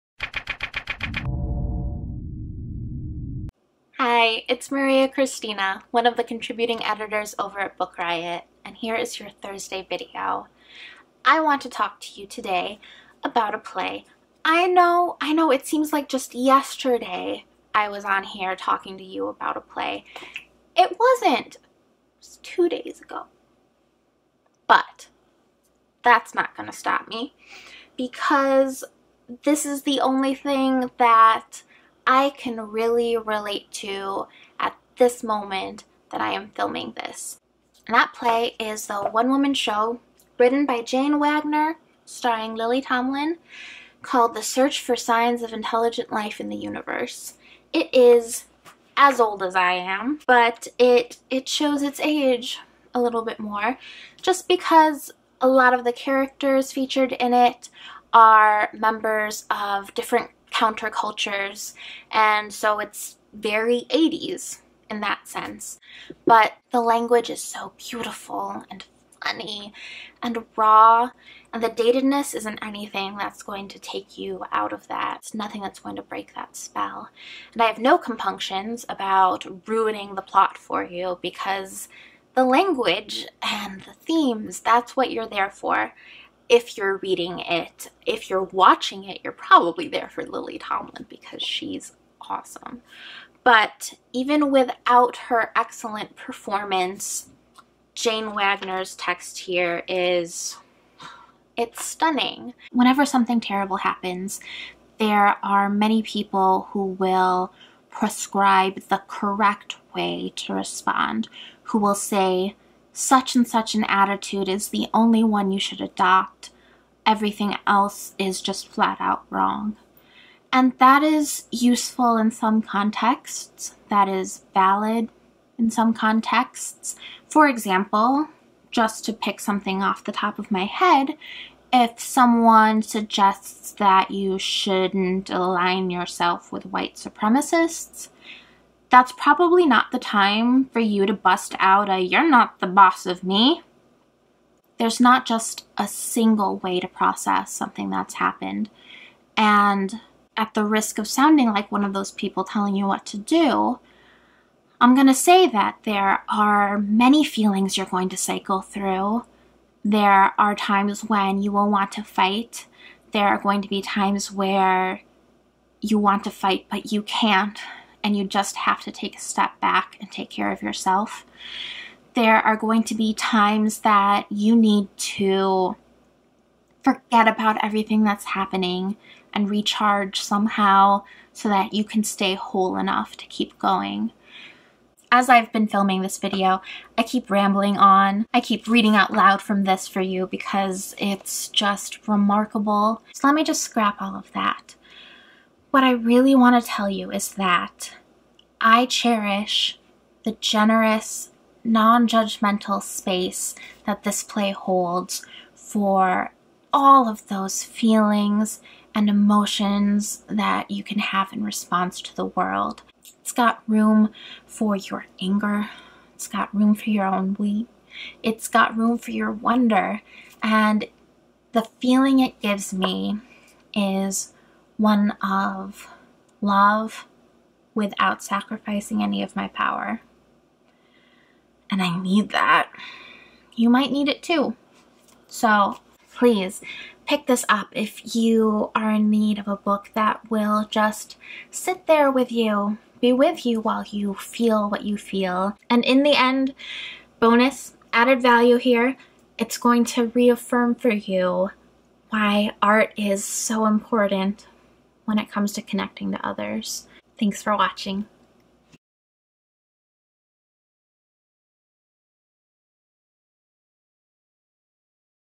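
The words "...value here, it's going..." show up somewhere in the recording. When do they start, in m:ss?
4:08.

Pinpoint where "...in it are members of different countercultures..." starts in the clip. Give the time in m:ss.
0:57.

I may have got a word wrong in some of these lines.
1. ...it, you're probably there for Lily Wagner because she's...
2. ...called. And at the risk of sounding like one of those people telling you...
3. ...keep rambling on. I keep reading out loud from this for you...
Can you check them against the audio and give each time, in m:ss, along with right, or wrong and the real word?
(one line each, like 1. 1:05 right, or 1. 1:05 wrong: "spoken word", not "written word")
1. 1:29 wrong: "Tomlin", not "Wagner"
2. 2:28 wrong: "happened", not "called"
3. 3:07 right.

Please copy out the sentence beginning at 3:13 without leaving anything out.
So let me just scrap all of that.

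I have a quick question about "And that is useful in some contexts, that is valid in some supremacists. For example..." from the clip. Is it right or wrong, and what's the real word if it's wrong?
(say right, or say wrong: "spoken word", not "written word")
wrong: "contexts", not "supremacists".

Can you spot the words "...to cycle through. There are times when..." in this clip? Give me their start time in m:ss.
2:38.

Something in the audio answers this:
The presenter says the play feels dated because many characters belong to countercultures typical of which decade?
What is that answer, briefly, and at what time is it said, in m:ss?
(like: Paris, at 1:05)
80s, at 1:03.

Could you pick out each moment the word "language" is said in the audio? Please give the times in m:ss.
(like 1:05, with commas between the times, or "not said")
1:06, 1:22.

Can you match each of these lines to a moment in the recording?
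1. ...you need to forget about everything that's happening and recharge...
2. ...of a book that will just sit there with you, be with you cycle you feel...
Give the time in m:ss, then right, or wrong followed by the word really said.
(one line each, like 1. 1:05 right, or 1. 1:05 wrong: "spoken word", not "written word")
1. 2:54 right
2. 3:59 wrong: "while", not "cycle".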